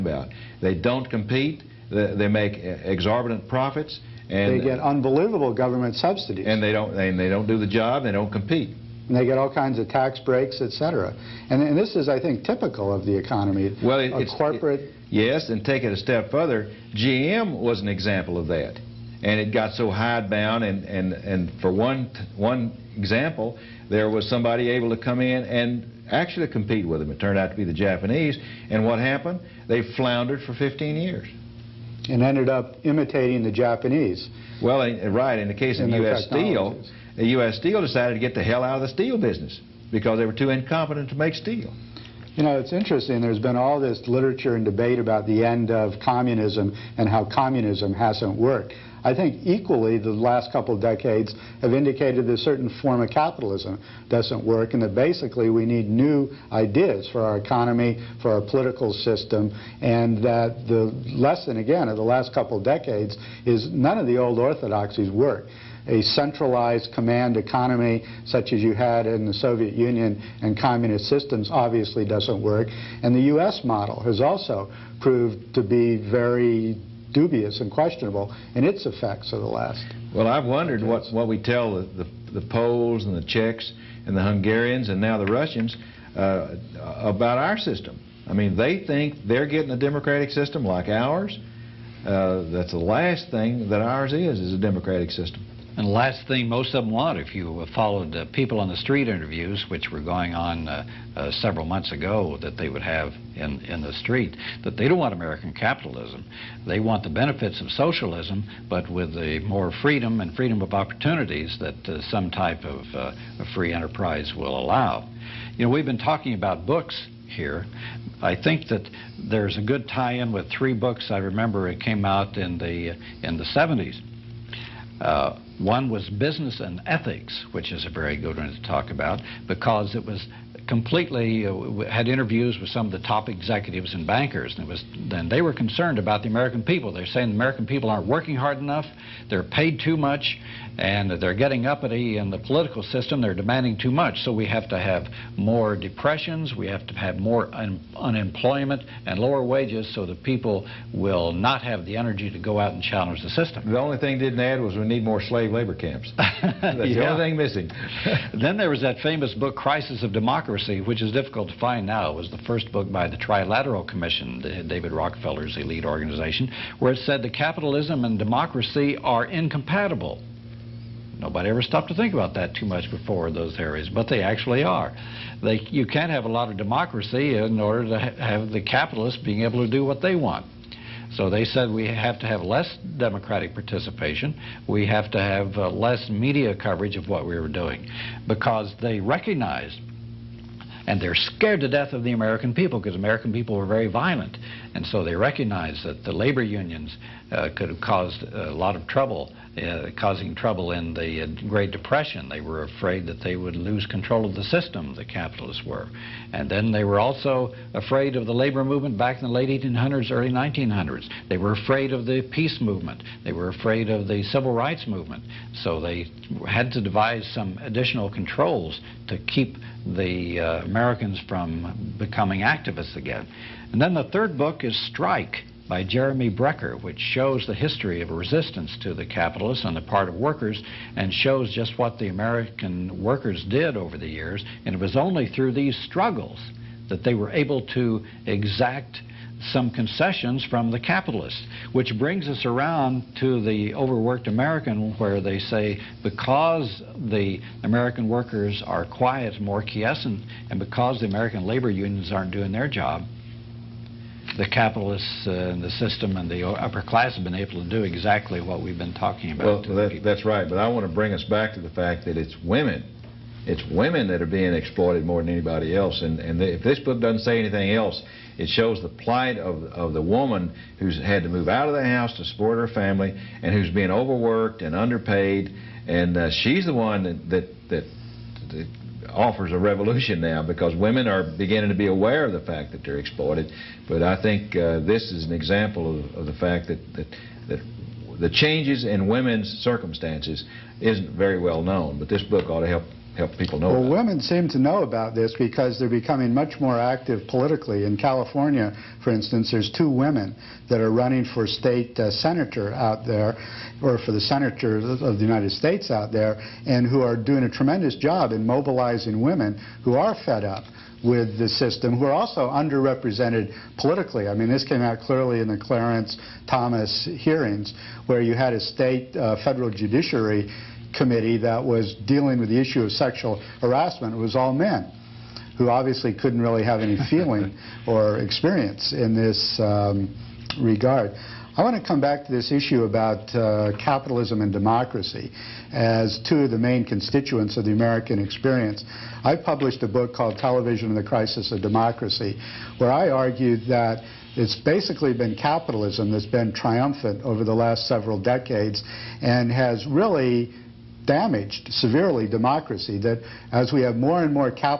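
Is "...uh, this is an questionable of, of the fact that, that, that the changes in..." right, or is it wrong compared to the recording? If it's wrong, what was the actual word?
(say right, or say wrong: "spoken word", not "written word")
wrong: "example", not "questionable".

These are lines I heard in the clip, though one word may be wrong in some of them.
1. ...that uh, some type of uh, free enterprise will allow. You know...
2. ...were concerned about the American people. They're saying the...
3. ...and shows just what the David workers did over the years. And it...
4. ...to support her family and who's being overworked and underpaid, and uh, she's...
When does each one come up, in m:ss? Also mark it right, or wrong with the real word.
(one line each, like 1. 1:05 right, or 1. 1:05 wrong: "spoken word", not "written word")
1. 1:51 right
2. 2:15 right
3. 3:50 wrong: "American", not "David"
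4. 4:32 right.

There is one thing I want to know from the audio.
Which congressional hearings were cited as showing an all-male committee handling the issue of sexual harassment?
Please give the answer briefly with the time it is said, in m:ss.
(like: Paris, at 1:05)
Clarence Thomas hearings, at 5:15.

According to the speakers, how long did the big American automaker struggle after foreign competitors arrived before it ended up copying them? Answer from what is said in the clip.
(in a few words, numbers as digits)
15 years.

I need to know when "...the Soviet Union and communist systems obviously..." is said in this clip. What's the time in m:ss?
1:09.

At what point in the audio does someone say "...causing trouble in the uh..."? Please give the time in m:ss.
3:19.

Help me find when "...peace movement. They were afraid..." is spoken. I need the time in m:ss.
3:32.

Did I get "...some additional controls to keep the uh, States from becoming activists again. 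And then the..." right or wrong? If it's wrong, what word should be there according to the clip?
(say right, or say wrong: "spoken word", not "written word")
wrong: "Americans", not "States".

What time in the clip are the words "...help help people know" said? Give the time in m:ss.
4:52.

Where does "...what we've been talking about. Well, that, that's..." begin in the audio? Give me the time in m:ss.
4:18.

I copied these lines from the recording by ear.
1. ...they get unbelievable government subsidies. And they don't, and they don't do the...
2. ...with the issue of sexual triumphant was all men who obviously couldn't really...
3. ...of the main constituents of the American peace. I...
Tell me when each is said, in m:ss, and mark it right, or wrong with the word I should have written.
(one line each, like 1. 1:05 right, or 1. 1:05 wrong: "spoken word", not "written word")
1. 0:04 right
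2. 5:22 wrong: "harassment", not "triumphant"
3. 5:36 wrong: "experience", not "peace".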